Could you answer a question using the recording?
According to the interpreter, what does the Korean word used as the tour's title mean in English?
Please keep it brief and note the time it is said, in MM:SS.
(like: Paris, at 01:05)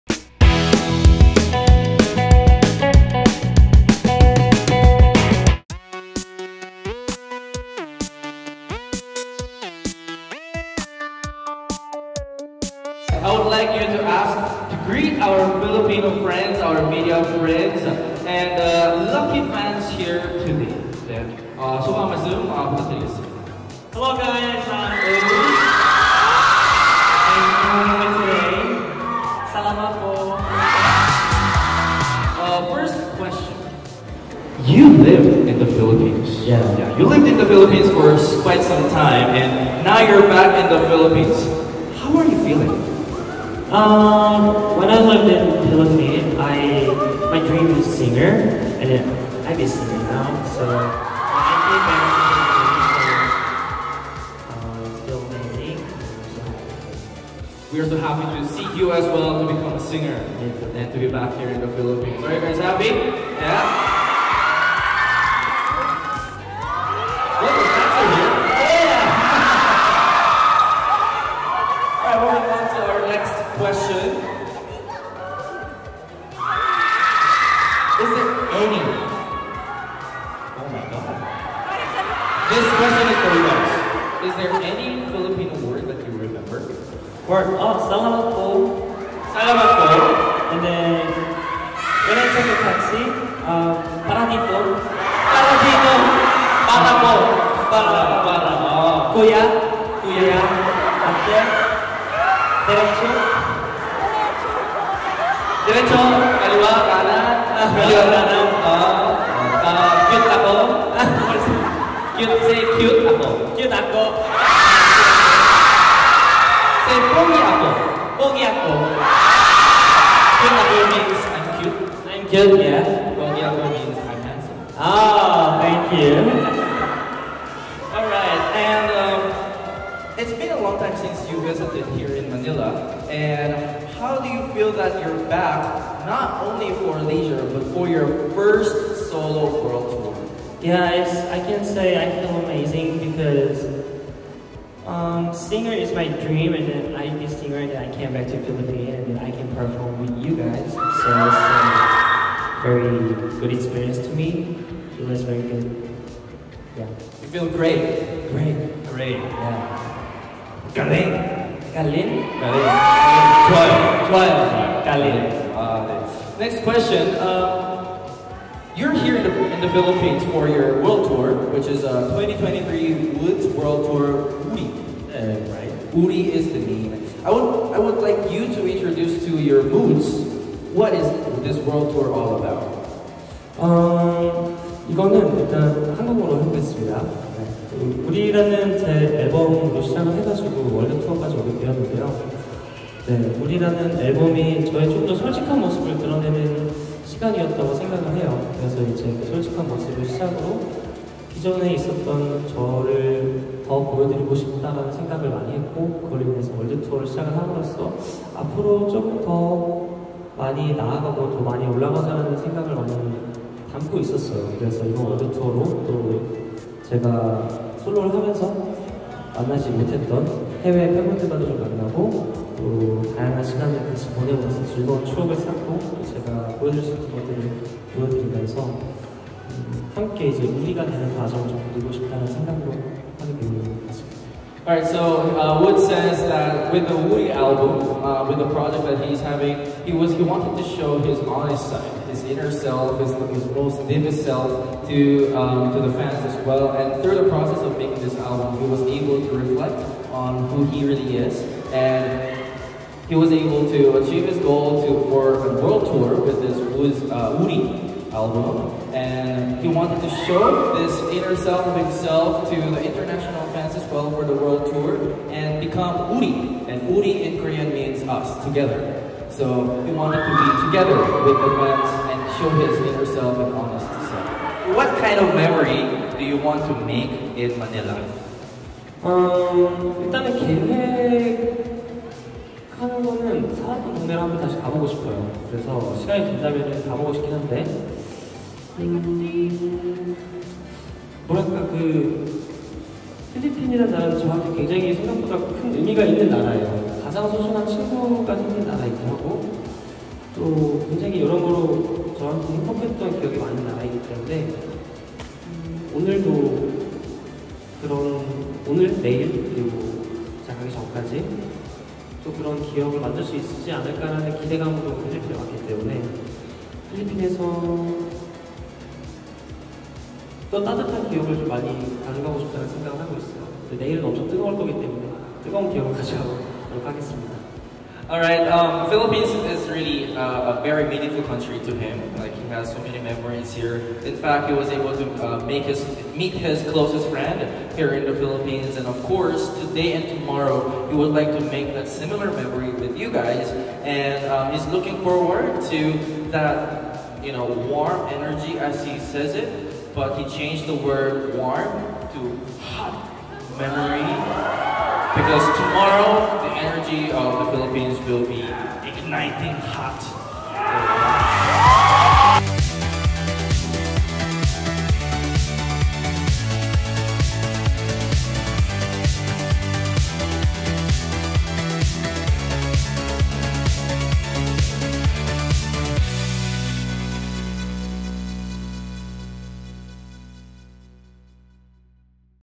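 us, together, at 04:28.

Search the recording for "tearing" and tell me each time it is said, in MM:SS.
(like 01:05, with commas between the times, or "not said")
not said.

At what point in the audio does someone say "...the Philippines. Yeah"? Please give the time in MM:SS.
00:35.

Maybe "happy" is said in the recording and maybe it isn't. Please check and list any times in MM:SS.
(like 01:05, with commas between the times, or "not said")
00:57, 01:02.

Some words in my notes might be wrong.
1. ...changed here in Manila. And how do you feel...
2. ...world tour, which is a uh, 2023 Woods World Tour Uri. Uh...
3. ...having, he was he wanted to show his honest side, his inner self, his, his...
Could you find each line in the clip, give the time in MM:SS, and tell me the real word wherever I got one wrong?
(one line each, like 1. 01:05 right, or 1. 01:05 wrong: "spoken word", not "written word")
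1. 02:11 wrong: "visited", not "changed"
2. 02:50 right
3. 03:59 right.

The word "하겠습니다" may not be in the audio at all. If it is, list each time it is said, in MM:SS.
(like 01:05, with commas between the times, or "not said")
05:26.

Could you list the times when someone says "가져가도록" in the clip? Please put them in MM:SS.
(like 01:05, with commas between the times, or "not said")
05:25.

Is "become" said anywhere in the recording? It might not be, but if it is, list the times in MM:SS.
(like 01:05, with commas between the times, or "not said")
00:59, 04:25.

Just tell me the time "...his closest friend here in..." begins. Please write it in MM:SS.
05:36.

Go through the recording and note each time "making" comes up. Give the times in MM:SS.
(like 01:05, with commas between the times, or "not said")
04:07.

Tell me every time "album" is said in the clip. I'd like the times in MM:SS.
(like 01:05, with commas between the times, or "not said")
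03:57, 04:08, 04:18.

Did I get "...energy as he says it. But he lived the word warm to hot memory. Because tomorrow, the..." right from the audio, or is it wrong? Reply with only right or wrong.
wrong.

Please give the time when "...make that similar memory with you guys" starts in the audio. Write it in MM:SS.
05:41.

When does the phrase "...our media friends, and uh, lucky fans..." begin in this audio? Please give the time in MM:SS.
00:16.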